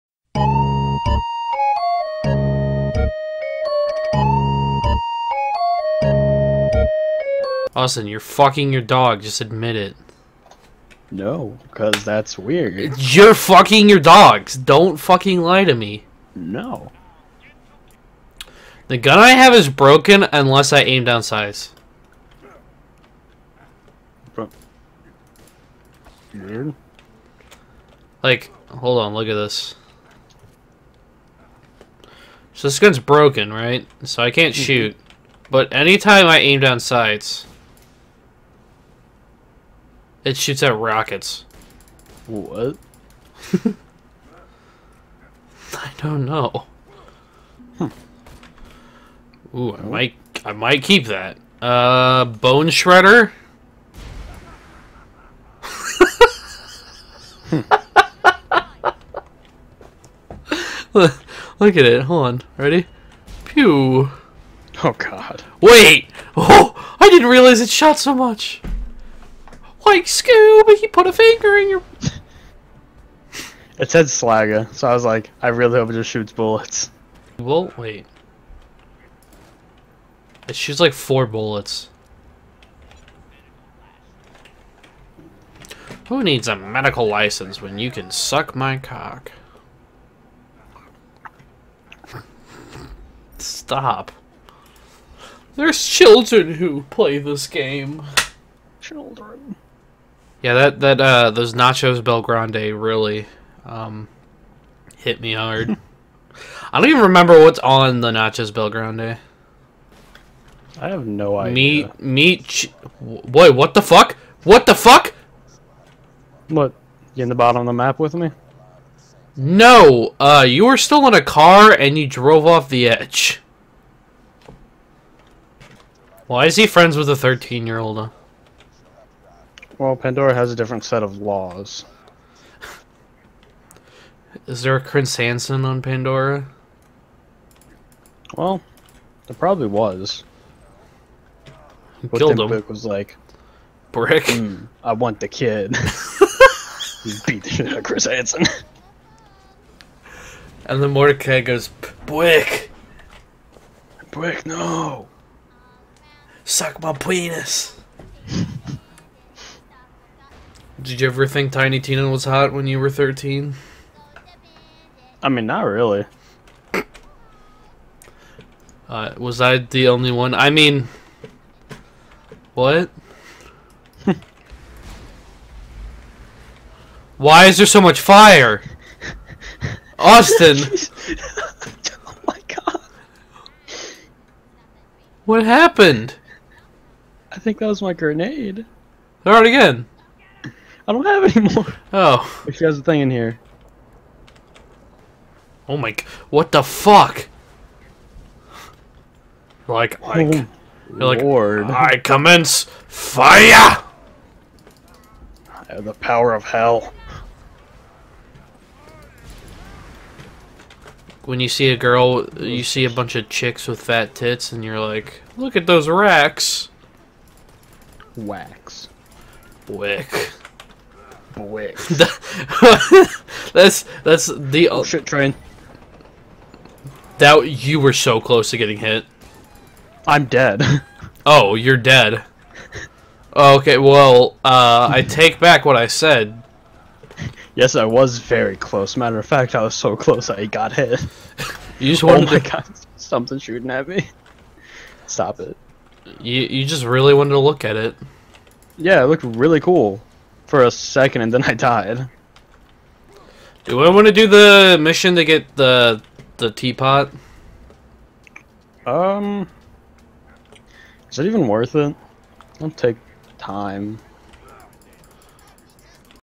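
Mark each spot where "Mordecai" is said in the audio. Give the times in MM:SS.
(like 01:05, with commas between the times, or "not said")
02:30.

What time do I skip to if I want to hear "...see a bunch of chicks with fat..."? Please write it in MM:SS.
03:32.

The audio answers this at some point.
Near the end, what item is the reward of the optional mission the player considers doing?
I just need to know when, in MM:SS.
04:16.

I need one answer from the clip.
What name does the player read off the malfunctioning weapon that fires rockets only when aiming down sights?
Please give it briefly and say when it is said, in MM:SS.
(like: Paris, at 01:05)
Bone Shredder, at 00:52.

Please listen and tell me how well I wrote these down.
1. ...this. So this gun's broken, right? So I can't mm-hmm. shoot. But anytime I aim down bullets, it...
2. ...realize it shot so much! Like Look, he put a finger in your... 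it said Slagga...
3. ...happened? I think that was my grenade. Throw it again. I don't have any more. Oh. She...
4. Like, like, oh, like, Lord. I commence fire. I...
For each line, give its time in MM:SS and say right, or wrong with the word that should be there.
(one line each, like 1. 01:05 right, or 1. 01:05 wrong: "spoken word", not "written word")
1. 00:29 wrong: "sights", not "bullets"
2. 01:07 wrong: "Scooby", not "Look"
3. 03:05 right
4. 03:19 right.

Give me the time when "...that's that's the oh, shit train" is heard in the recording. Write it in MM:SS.
03:43.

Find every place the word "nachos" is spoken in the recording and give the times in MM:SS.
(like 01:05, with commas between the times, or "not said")
01:41, 01:48.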